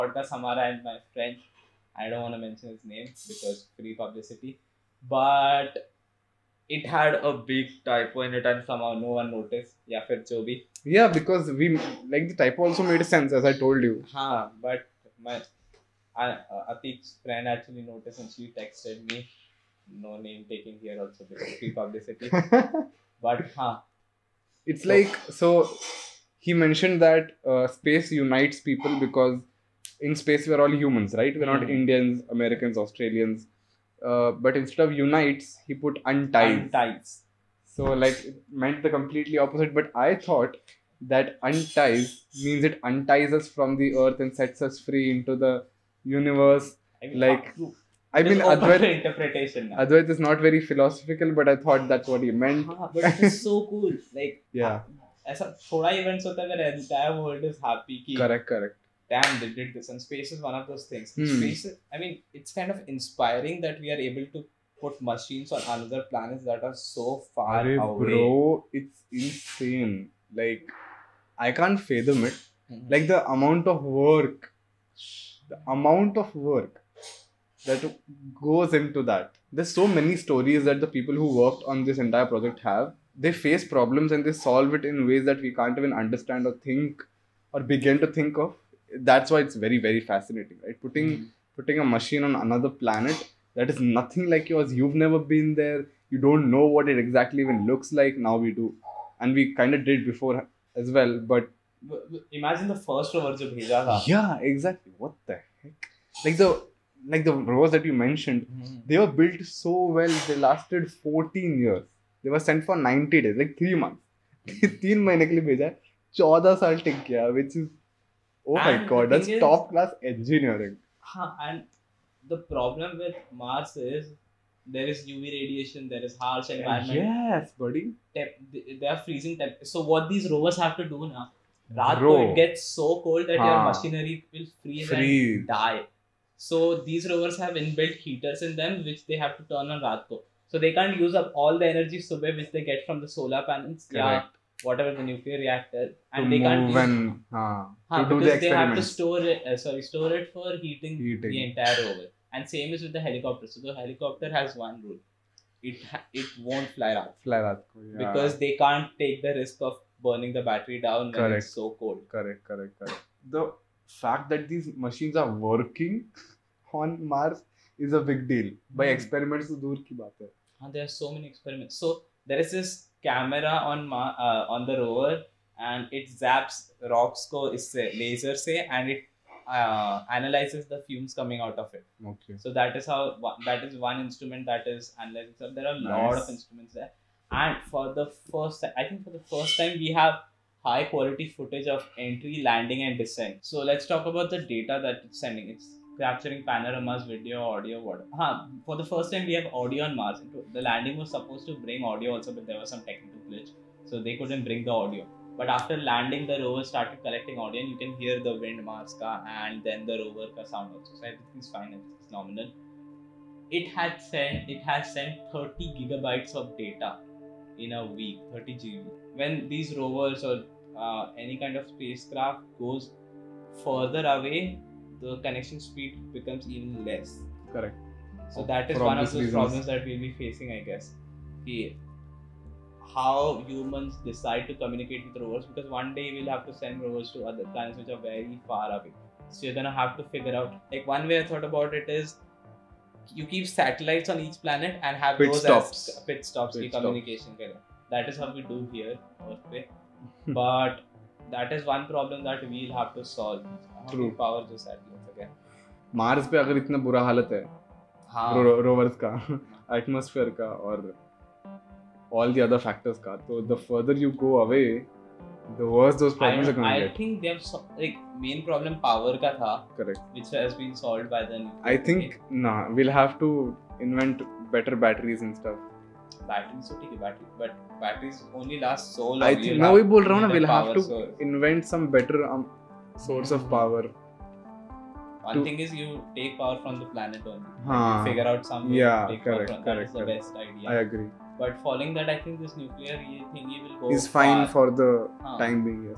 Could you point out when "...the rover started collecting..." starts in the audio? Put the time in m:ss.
3:26.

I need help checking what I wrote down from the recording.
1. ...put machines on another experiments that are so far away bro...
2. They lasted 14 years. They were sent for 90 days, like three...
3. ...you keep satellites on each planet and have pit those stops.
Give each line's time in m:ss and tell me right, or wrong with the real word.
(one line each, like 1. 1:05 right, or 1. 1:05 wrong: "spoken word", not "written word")
1. 1:04 wrong: "planets", not "experiments"
2. 1:50 right
3. 4:03 right.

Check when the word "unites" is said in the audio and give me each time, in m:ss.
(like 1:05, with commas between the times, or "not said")
0:28, 0:35.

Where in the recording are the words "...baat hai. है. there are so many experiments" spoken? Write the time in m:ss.
2:49.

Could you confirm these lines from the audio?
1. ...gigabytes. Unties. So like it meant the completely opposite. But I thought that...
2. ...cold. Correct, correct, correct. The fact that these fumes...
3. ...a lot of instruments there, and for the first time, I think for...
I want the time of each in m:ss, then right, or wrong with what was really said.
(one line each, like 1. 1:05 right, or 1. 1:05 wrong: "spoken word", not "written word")
1. 0:36 wrong: "unties", not "gigabytes"
2. 2:41 wrong: "machines", not "fumes"
3. 3:05 right.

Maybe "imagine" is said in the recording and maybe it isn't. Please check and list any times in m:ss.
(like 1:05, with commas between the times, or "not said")
1:42.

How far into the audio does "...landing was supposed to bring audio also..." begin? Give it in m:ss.
3:20.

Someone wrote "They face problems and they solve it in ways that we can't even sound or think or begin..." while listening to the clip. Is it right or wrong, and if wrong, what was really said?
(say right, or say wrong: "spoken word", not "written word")
wrong: "understand", not "sound".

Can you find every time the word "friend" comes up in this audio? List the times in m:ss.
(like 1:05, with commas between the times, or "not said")
0:01, 0:17.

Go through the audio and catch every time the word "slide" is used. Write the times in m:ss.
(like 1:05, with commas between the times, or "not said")
not said.